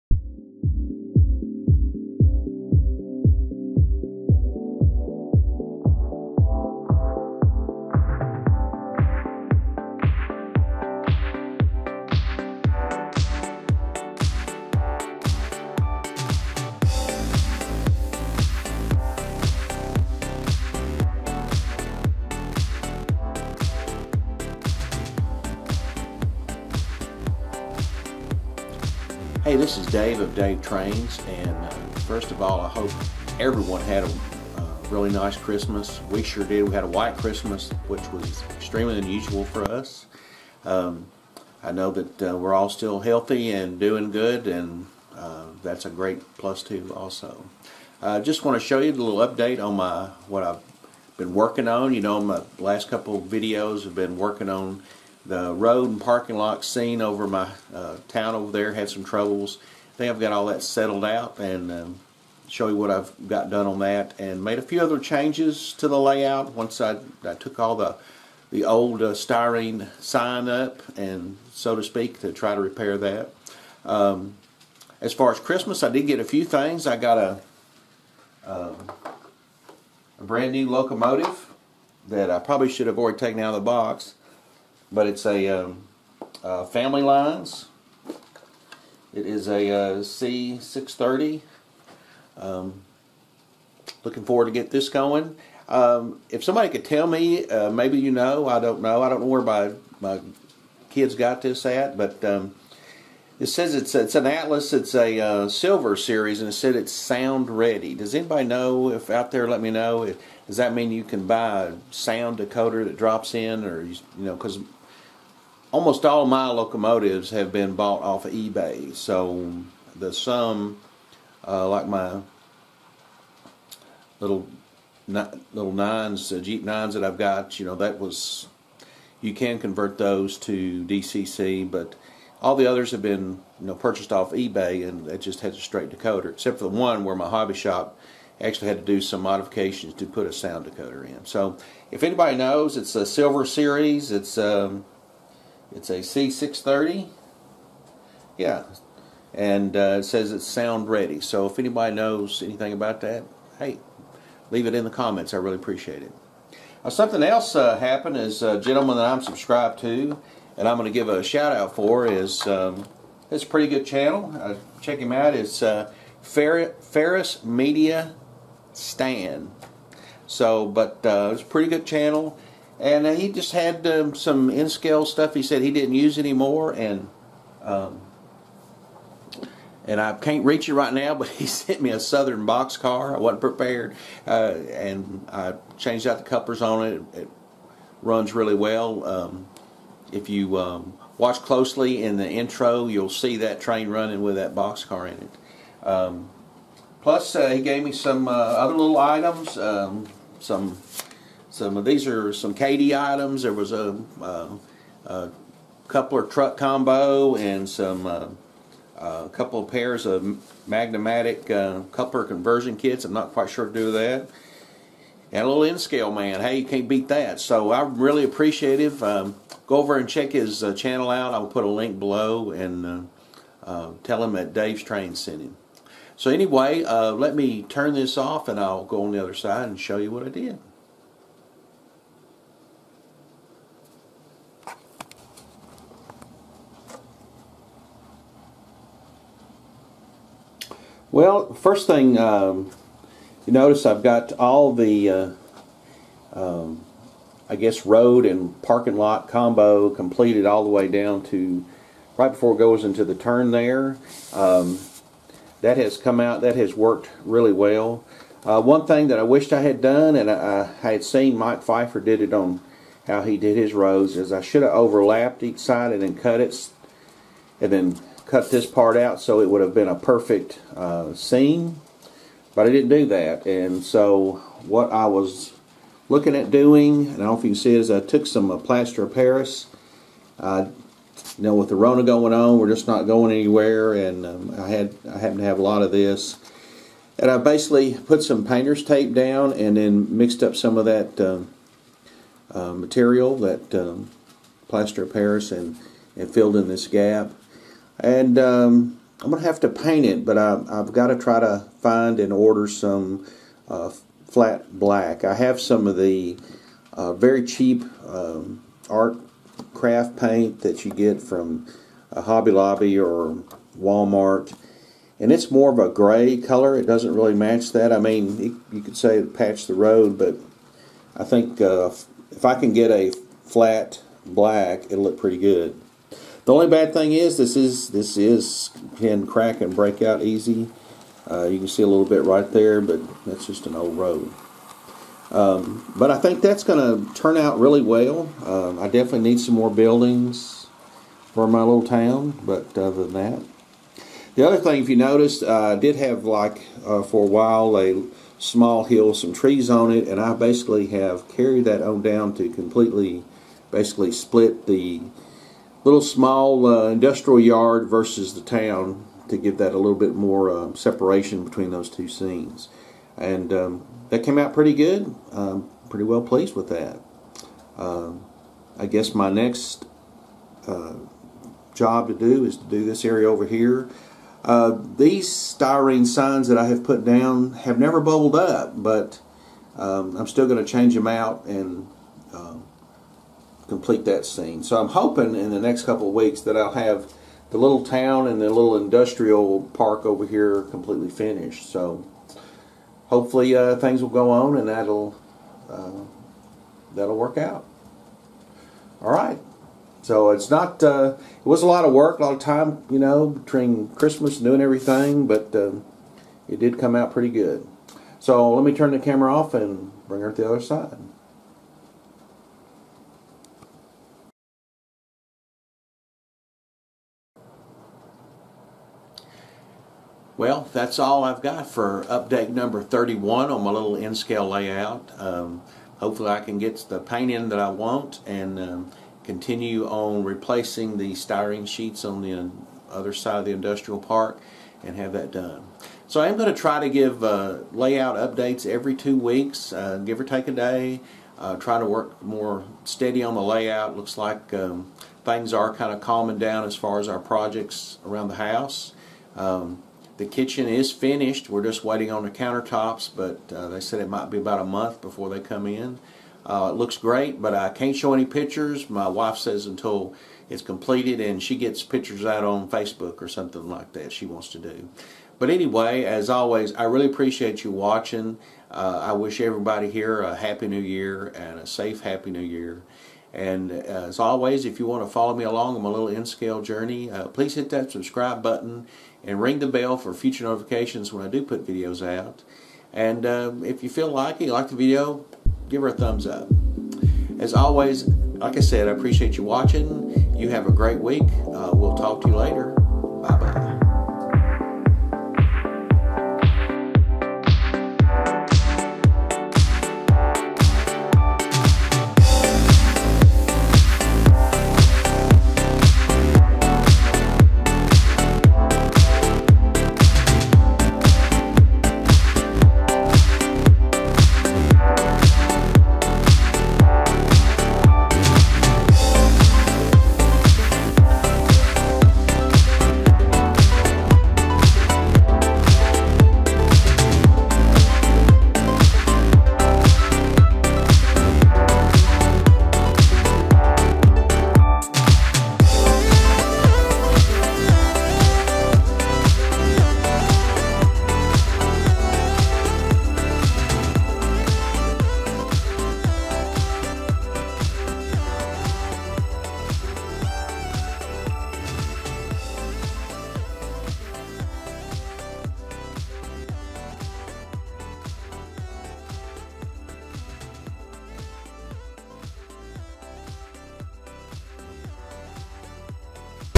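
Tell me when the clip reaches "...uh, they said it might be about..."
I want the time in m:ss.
7:33.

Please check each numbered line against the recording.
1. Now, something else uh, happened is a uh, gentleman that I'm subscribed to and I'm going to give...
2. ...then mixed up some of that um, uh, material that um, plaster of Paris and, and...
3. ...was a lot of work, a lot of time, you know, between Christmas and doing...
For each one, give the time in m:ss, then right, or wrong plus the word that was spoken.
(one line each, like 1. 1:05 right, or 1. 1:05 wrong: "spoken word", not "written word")
1. 2:36 right
2. 4:49 right
3. 6:41 right.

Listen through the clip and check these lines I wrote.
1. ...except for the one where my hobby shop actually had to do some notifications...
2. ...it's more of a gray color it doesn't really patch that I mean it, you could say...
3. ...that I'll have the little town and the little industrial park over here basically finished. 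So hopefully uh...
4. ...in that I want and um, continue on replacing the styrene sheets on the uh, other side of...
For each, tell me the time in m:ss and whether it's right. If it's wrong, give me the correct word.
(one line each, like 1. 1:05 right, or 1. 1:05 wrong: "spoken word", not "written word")
1. 2:16 wrong: "modifications", not "notifications"
2. 5:15 wrong: "match", not "patch"
3. 6:26 wrong: "completely", not "basically"
4. 7:07 right.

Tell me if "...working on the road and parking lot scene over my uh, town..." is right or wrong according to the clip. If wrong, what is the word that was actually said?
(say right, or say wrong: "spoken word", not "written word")
right.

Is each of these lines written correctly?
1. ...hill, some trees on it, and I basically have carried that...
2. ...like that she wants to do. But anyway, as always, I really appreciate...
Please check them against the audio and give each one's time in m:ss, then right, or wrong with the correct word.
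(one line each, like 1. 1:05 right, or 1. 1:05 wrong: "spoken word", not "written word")
1. 5:48 right
2. 7:43 right.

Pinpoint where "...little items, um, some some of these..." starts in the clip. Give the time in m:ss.
3:18.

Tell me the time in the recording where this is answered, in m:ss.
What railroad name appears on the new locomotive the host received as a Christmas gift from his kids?
1:26.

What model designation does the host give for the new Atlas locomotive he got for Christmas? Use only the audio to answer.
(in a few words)
C630.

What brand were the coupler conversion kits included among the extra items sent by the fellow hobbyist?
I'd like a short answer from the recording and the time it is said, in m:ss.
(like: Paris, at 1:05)
Magne-Matic, at 3:30.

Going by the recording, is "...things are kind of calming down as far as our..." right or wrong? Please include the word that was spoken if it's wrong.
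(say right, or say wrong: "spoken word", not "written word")
right.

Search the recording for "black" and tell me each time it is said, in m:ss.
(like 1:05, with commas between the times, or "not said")
5:04, 5:24.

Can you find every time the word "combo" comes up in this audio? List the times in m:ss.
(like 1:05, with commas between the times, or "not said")
3:26, 4:09.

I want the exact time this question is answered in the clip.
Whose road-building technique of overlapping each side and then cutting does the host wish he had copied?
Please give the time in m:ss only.
4:21.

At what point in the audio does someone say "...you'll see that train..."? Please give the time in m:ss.
3:12.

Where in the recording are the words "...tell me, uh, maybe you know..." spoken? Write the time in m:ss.
1:36.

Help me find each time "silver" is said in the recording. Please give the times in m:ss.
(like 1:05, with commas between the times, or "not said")
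1:45, 2:23.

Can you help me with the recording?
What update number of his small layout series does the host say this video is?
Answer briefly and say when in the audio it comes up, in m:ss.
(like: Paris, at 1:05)
31, at 7:02.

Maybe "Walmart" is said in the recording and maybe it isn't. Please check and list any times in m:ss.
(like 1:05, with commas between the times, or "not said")
5:13.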